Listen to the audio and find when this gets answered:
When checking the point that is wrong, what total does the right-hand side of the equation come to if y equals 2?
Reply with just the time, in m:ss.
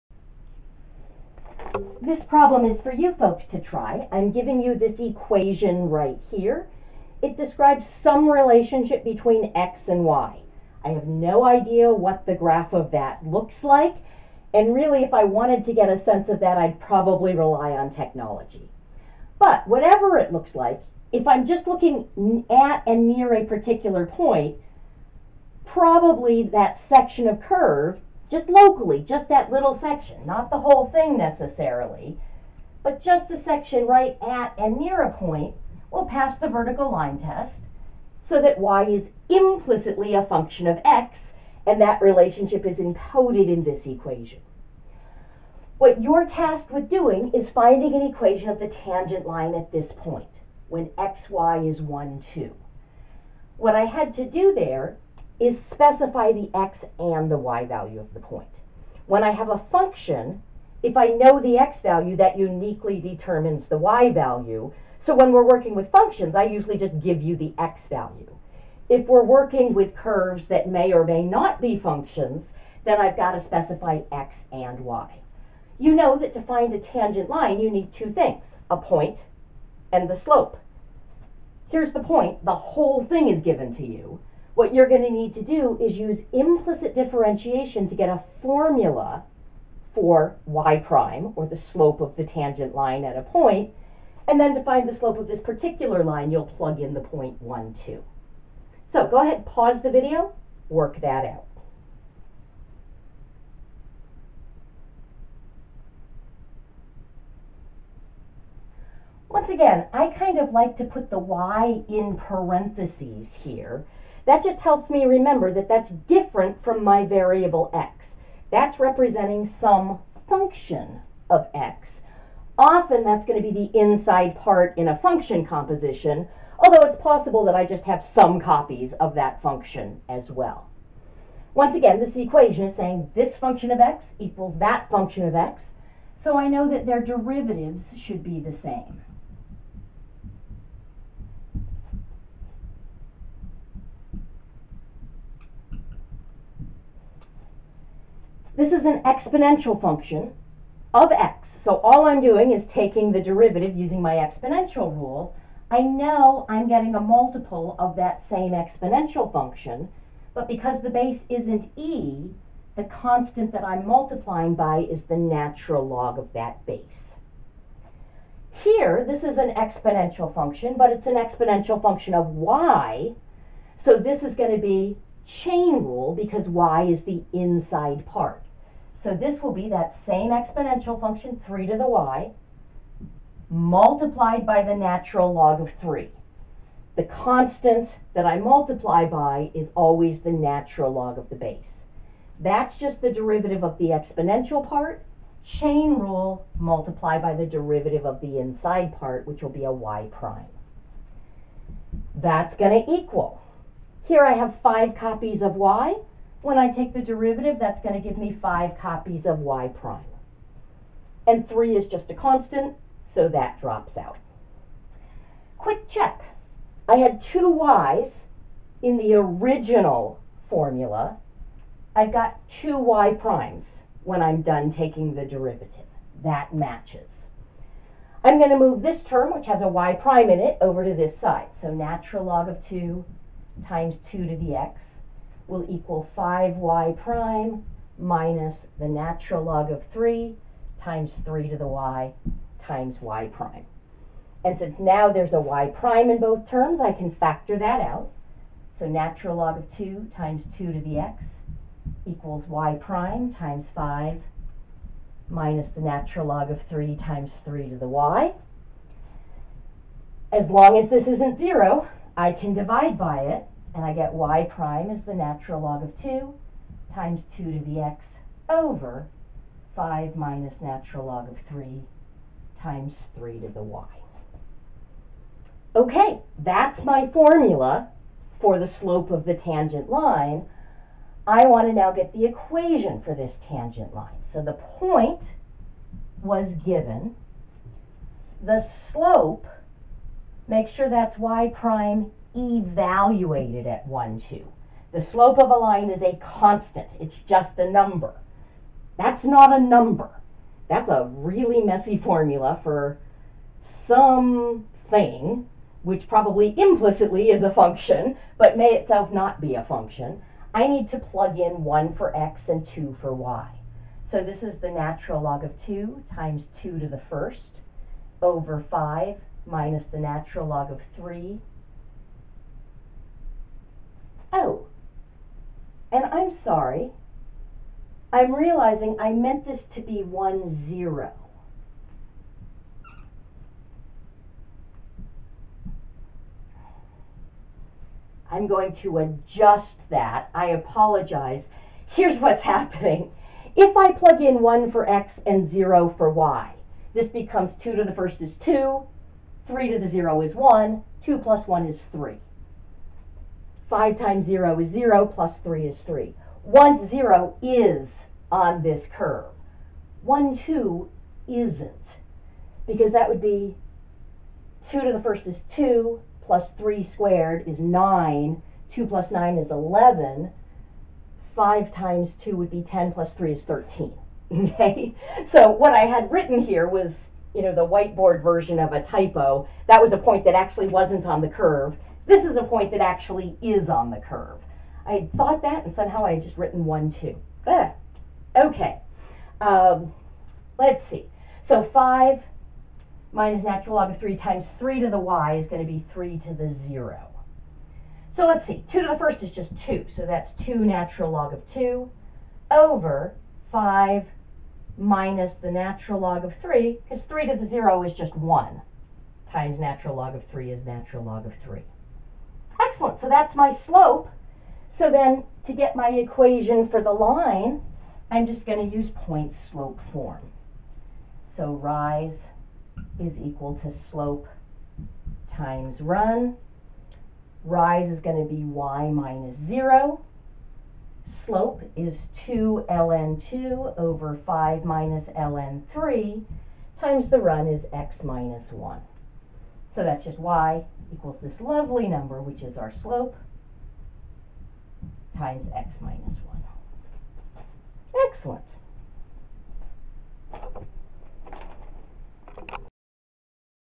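6:13.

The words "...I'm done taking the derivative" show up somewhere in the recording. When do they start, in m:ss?
3:44.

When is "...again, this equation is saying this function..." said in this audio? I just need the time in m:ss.
2:11.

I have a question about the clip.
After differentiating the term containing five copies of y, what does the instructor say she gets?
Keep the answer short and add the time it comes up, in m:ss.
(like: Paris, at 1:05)
5 copies of y prime, at 3:28.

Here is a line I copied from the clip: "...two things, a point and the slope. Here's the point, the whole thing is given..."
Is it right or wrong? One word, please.
right.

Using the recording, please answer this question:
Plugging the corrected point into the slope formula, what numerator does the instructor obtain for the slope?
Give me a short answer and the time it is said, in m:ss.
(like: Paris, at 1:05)
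2 natural log of 2, at 6:40.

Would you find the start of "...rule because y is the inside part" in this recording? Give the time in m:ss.
2:55.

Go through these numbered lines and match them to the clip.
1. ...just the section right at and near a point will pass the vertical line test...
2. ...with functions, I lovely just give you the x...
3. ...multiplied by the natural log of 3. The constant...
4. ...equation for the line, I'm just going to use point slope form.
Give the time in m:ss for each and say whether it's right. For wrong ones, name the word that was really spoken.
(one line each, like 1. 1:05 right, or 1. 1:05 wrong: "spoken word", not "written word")
1. 0:33 right
2. 1:05 wrong: "usually", not "lovely"
3. 3:03 right
4. 6:55 right.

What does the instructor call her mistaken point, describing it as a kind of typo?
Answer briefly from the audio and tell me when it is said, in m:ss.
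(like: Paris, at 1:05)
the whiteboard version, at 6:17.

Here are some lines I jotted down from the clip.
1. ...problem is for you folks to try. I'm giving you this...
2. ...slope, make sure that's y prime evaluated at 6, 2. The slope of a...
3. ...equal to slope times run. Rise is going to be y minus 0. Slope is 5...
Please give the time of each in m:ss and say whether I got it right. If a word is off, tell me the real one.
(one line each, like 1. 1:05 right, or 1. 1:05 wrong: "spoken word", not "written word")
1. 0:02 right
2. 4:48 wrong: "1", not "6"
3. 7:03 wrong: "2", not "5".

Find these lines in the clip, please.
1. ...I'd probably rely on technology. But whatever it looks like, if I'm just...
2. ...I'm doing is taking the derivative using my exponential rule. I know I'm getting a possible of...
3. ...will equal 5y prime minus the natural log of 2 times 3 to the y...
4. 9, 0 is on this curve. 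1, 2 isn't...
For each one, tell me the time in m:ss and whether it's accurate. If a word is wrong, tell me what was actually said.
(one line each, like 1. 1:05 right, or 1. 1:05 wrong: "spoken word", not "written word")
1. 0:16 right
2. 2:32 wrong: "multiple", not "possible"
3. 3:55 wrong: "3", not "2"
4. 5:56 wrong: "1", not "9".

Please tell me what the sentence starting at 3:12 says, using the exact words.
That's just the derivative of the exponential part.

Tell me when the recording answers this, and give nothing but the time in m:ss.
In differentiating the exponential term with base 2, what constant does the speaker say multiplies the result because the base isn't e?
2:45.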